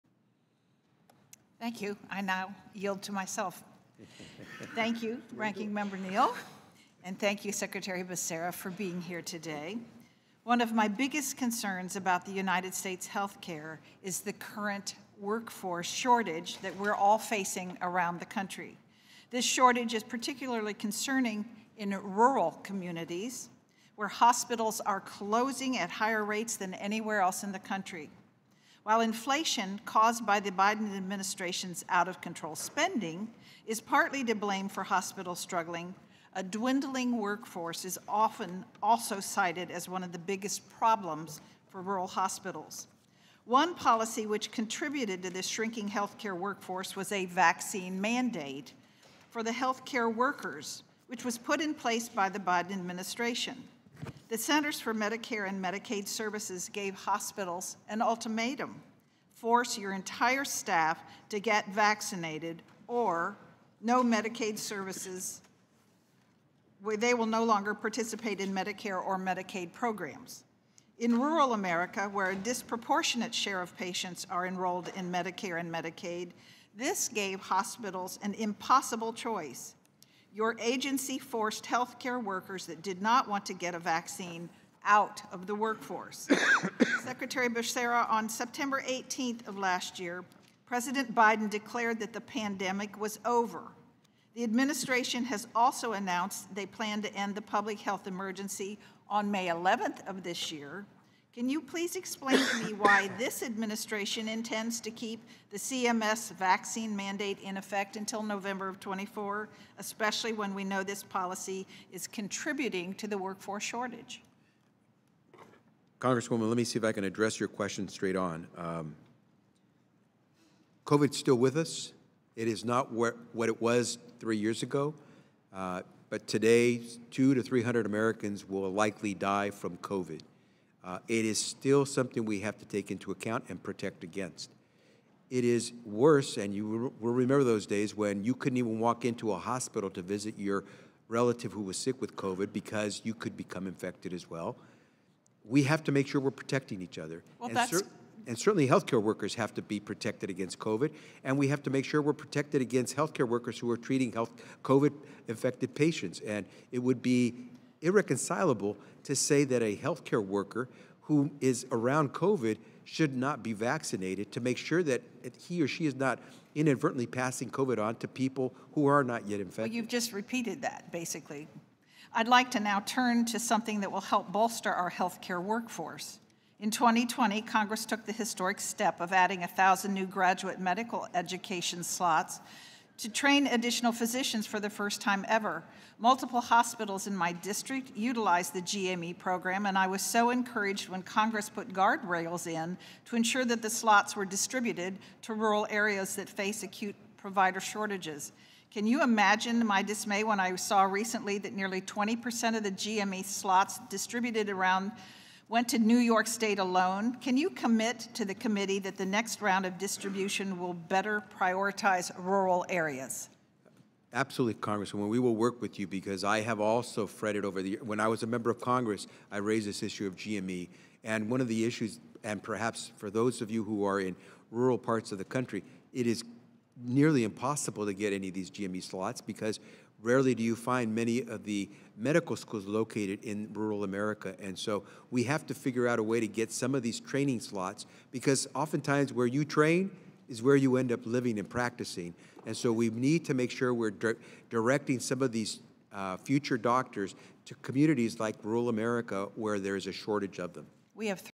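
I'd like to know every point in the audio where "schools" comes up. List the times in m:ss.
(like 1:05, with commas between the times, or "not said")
3:52.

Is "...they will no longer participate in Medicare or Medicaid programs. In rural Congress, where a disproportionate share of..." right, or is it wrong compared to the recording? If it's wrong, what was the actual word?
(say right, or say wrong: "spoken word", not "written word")
wrong: "America", not "Congress".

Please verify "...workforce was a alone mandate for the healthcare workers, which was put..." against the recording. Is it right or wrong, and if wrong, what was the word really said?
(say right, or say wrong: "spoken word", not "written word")
wrong: "vaccine", not "alone".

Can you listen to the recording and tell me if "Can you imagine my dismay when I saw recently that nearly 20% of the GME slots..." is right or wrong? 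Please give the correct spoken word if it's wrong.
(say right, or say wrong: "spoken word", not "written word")
right.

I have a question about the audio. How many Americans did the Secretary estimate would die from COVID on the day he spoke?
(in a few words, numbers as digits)
200 to 300.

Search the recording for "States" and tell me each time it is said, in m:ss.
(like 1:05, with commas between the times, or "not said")
0:12, 3:26.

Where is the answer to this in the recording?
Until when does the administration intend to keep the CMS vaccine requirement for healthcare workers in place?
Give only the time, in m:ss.
1:48.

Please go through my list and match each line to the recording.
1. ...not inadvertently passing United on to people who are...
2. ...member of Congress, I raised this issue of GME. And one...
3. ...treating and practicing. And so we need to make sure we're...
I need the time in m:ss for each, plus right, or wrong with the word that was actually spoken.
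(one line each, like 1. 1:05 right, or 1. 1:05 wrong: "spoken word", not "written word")
1. 2:45 wrong: "COVID", not "United"
2. 3:38 right
3. 4:01 wrong: "living", not "treating".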